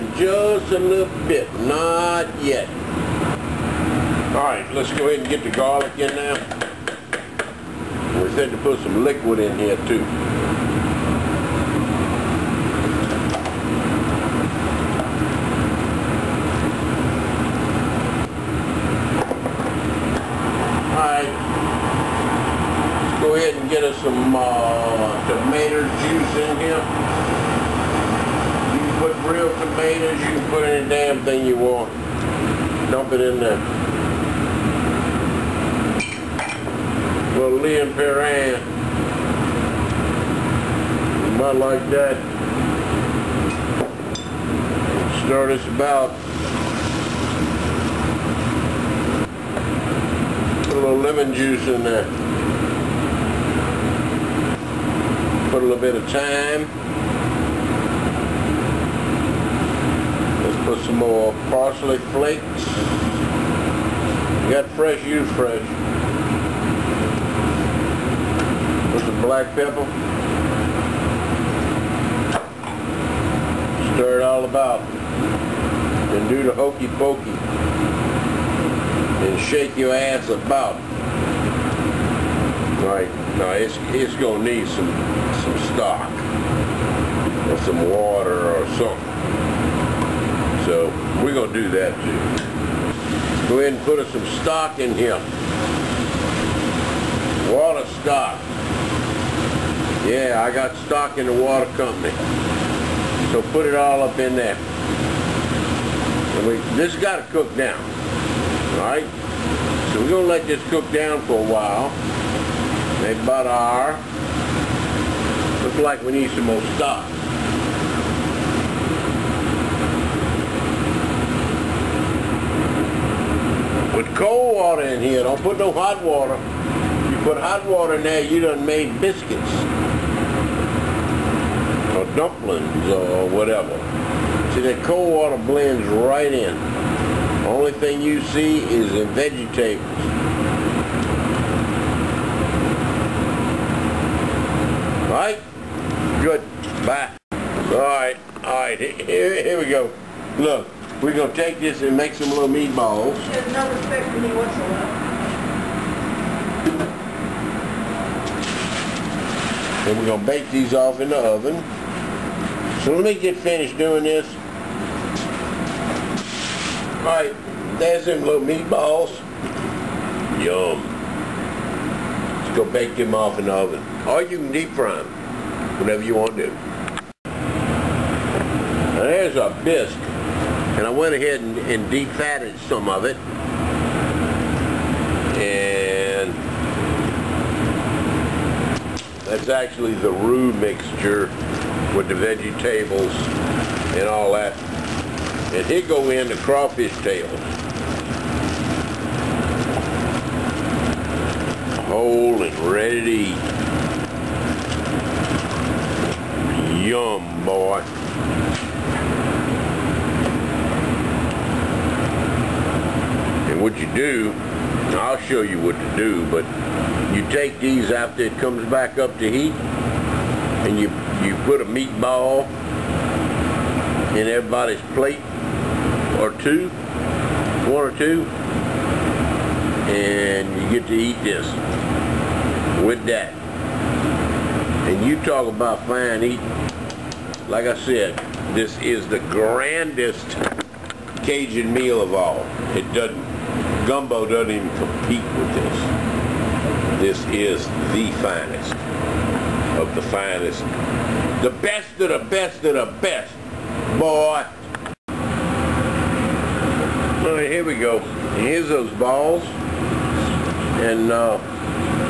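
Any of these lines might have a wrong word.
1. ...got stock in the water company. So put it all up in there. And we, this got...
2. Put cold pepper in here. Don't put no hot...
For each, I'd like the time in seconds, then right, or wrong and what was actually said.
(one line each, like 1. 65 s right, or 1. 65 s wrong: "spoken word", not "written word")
1. 100 s right
2. 123 s wrong: "water", not "pepper".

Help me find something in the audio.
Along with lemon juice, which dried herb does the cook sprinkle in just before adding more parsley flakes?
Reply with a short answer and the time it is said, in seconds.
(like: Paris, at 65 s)
thyme, at 56 s.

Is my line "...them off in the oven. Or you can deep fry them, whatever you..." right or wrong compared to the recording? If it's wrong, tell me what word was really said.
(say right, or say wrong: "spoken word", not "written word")
right.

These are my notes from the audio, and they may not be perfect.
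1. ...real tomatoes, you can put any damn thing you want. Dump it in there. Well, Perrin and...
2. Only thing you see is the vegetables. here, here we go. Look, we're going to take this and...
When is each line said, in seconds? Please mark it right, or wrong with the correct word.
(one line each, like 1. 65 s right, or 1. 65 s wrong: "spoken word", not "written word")
1. 29 s wrong: "Lea", not "Perrin"
2. 137 s right.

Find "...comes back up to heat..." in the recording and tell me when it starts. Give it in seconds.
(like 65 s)
218 s.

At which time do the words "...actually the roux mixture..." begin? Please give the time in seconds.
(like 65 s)
189 s.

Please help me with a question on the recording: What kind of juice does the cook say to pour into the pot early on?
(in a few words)
tomato juice.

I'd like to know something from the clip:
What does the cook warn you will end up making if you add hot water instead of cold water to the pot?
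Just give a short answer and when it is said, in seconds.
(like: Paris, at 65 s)
biscuits, at 129 s.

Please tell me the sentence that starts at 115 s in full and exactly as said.
Looks like we need some more stock.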